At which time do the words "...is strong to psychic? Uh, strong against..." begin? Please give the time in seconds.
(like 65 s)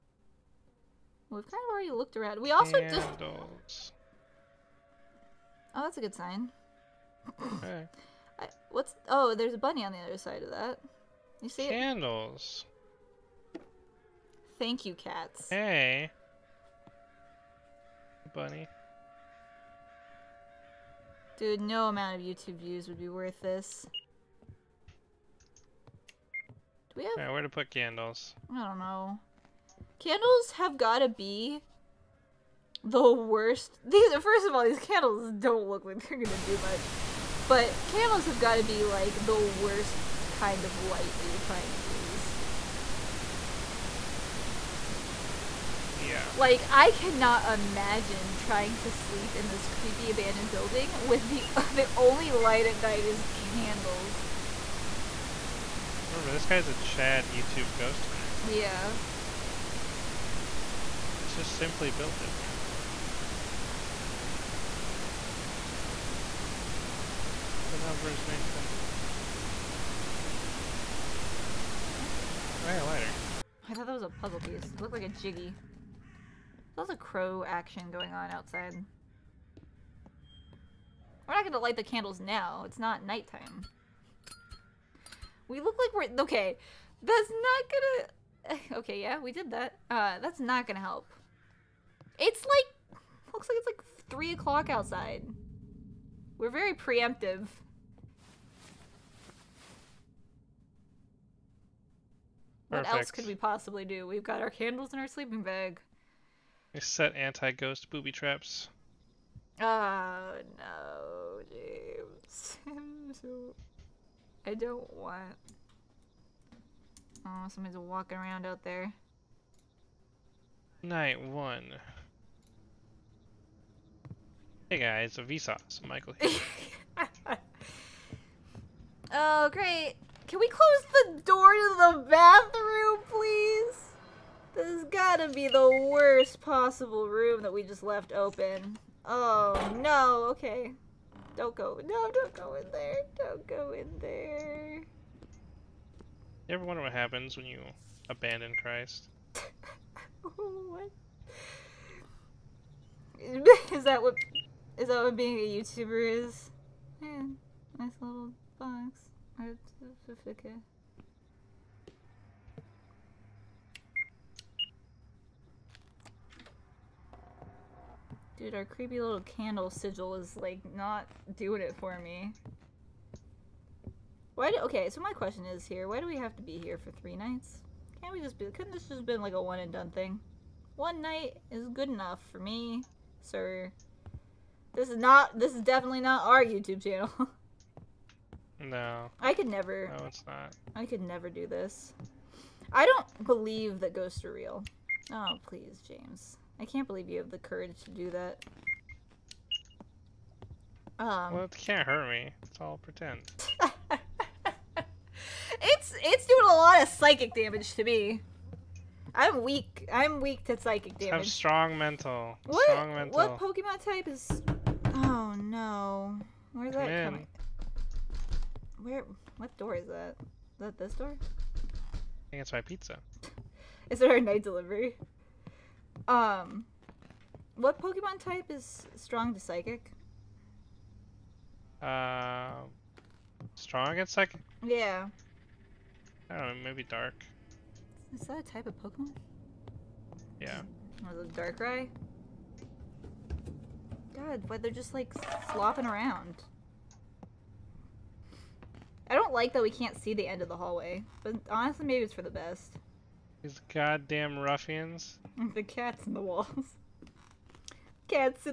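228 s.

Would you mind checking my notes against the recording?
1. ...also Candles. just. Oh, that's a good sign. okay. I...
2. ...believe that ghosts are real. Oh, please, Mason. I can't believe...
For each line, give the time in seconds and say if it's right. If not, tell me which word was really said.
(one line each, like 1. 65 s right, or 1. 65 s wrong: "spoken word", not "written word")
1. 2 s right
2. 193 s wrong: "James", not "Mason".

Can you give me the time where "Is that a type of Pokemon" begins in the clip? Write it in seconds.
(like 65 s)
238 s.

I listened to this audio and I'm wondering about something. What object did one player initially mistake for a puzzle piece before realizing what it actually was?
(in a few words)
Lighter.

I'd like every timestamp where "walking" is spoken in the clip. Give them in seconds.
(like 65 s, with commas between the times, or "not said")
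117 s.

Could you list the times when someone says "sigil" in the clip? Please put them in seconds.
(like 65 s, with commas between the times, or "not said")
169 s.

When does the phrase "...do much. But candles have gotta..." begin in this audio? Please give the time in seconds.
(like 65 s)
36 s.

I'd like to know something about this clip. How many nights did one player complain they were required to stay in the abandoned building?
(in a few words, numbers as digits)
3.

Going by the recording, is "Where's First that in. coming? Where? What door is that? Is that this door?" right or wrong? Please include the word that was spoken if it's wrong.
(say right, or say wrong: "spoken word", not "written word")
wrong: "Come", not "First".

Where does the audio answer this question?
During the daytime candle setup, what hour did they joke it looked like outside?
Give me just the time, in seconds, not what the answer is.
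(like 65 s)
94 s.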